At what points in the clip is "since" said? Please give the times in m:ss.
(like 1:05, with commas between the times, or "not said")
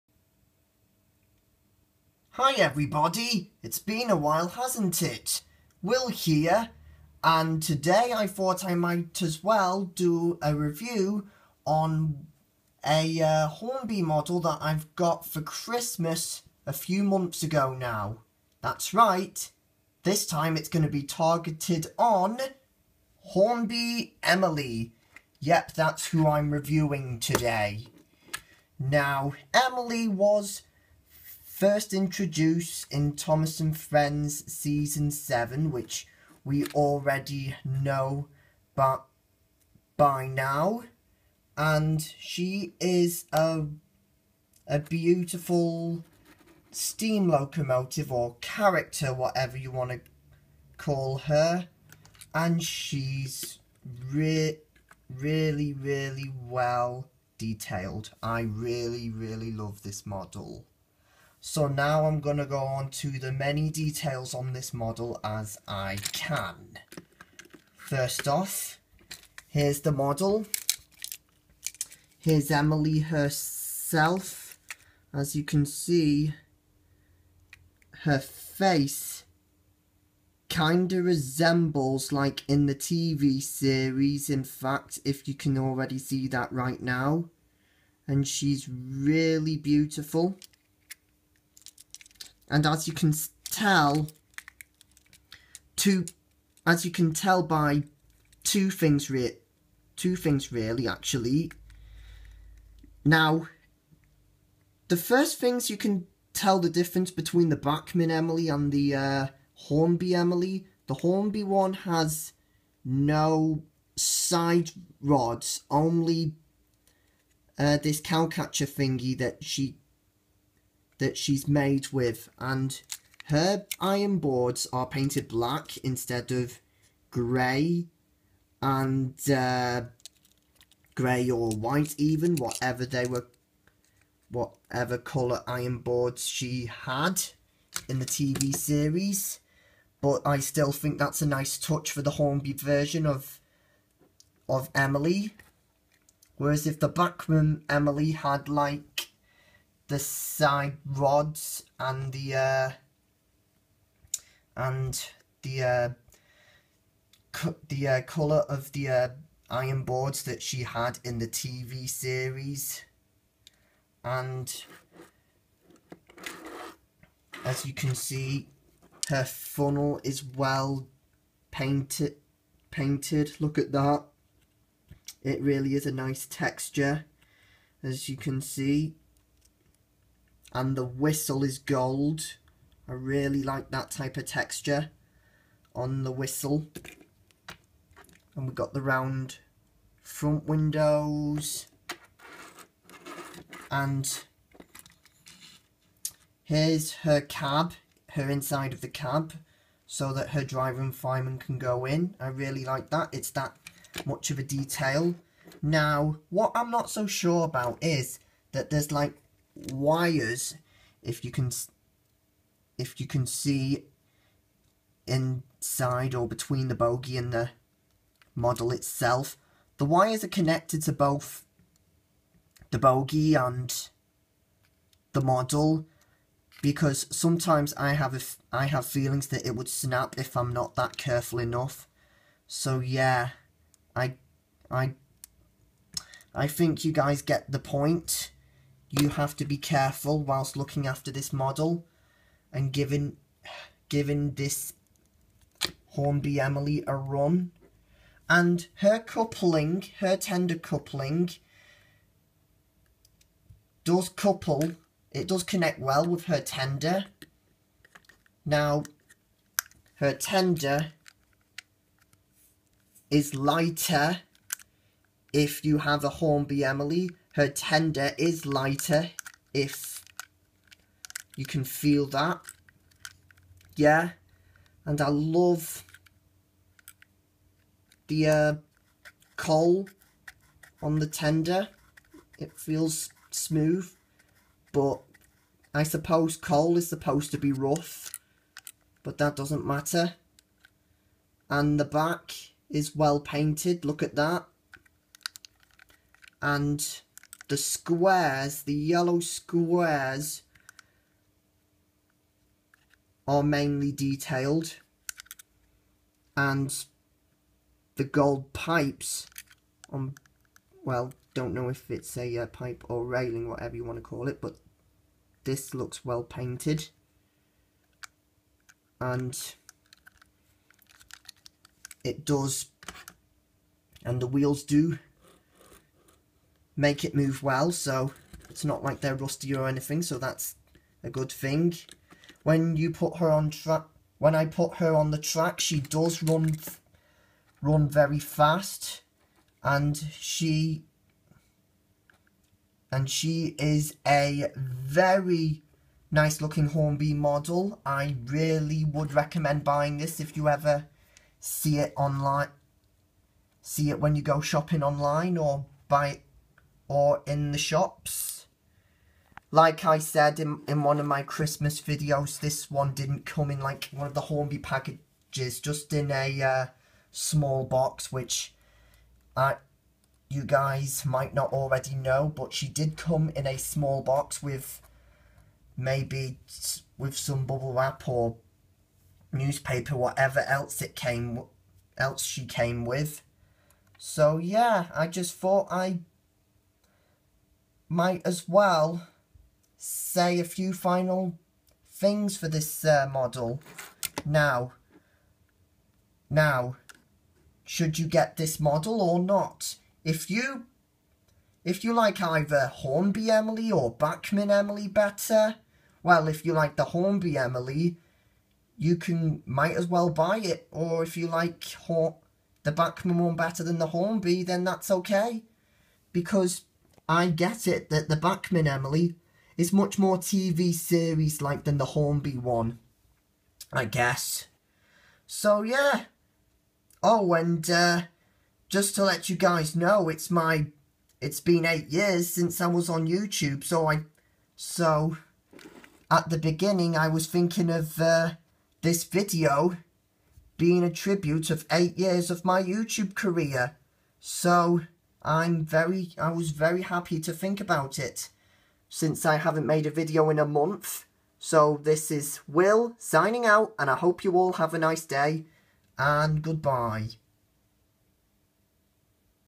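7:12, 7:28.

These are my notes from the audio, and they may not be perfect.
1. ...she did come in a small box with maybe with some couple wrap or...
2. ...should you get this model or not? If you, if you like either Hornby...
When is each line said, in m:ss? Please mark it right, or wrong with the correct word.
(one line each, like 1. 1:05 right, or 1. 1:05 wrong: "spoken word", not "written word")
1. 6:12 wrong: "bubble", not "couple"
2. 6:37 right.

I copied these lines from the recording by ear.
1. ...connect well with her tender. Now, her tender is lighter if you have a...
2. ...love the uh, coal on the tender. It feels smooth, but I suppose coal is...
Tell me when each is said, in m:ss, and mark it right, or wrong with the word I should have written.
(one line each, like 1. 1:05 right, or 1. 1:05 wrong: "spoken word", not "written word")
1. 4:15 right
2. 4:35 right.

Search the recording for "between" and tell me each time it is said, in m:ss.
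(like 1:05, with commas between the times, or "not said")
1:47, 3:36.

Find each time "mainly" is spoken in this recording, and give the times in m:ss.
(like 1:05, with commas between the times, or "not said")
5:03.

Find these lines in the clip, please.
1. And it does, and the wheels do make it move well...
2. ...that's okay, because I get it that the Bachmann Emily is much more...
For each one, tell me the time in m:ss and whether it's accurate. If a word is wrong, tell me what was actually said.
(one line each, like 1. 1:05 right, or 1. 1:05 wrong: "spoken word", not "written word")
1. 5:19 right
2. 6:54 right.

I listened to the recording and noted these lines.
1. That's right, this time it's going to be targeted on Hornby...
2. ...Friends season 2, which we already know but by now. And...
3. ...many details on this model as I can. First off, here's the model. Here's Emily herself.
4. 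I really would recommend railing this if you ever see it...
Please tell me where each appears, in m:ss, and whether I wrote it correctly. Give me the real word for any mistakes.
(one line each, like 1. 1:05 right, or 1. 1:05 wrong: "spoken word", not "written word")
1. 0:18 right
2. 0:33 wrong: "7", not "2"
3. 1:03 right
4. 5:47 wrong: "buying", not "railing".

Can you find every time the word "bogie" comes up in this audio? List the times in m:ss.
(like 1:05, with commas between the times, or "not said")
3:36, 3:42.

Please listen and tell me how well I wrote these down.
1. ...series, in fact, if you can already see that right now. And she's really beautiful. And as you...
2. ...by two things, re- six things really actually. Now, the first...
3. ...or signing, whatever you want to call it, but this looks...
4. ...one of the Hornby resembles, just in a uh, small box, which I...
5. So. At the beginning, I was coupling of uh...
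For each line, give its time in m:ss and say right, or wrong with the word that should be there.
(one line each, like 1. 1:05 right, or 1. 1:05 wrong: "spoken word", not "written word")
1. 1:23 right
2. 1:37 wrong: "two", not "six"
3. 5:12 wrong: "railing", not "signing"
4. 6:03 wrong: "packages", not "resembles"
5. 7:14 wrong: "thinking", not "coupling".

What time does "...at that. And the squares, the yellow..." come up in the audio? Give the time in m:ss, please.
4:54.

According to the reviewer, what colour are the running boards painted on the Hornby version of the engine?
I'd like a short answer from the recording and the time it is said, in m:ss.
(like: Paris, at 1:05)
Black, at 2:05.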